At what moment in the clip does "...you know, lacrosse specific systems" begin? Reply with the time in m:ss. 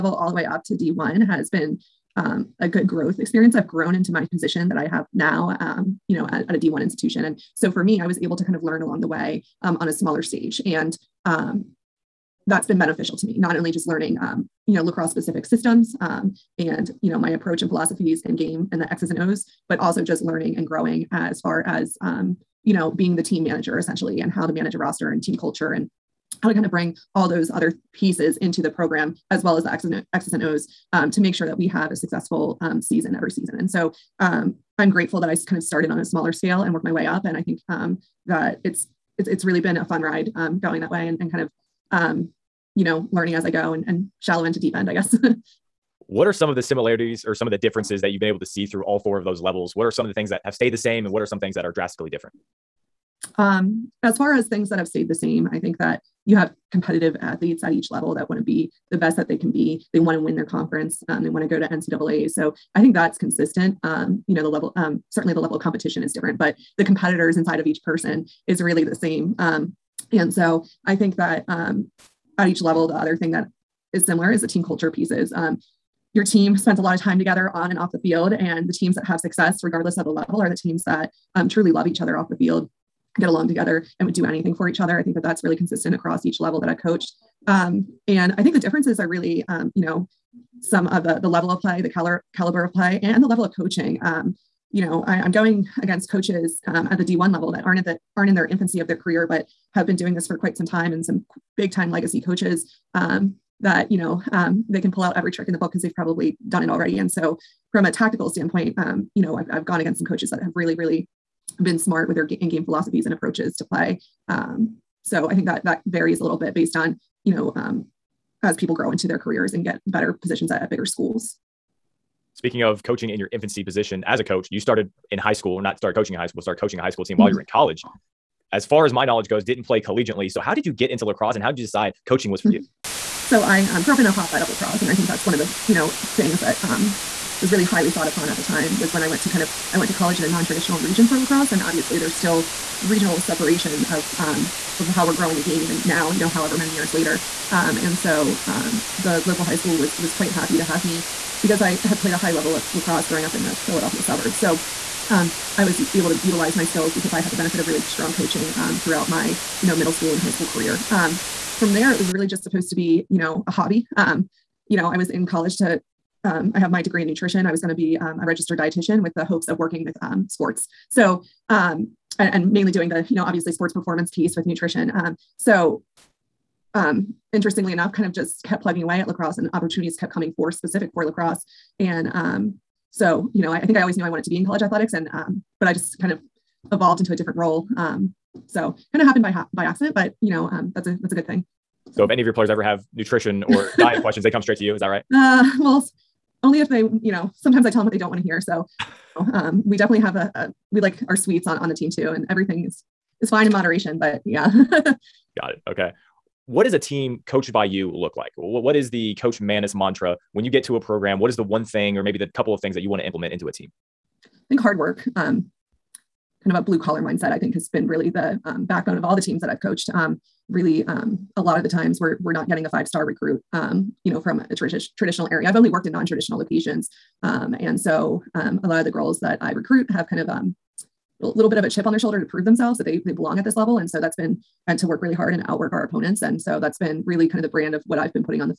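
0:14.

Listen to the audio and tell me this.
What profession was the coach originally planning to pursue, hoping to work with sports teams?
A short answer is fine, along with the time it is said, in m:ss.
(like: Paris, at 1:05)
Registered dietitian, at 2:48.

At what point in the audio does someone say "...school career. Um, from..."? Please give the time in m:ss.
2:40.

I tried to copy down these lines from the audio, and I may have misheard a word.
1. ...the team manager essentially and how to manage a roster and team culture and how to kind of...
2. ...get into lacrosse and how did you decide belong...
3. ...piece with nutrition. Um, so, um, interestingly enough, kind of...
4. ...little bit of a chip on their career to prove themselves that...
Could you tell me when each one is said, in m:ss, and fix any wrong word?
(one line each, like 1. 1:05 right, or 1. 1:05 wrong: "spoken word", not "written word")
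1. 0:23 right
2. 2:10 wrong: "coaching", not "belong"
3. 2:54 right
4. 3:51 wrong: "shoulder", not "career".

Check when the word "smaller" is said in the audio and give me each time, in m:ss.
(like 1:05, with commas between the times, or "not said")
0:09, 0:36.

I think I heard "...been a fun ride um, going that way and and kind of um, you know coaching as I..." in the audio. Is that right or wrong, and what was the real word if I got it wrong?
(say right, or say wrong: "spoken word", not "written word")
wrong: "learning", not "coaching".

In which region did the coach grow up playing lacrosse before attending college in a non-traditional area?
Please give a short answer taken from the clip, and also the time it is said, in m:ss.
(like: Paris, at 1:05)
Philadelphia suburbs, at 2:33.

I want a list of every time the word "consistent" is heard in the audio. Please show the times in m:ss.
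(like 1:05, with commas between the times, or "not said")
1:03, 1:25.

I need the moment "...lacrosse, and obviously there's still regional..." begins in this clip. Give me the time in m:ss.
2:21.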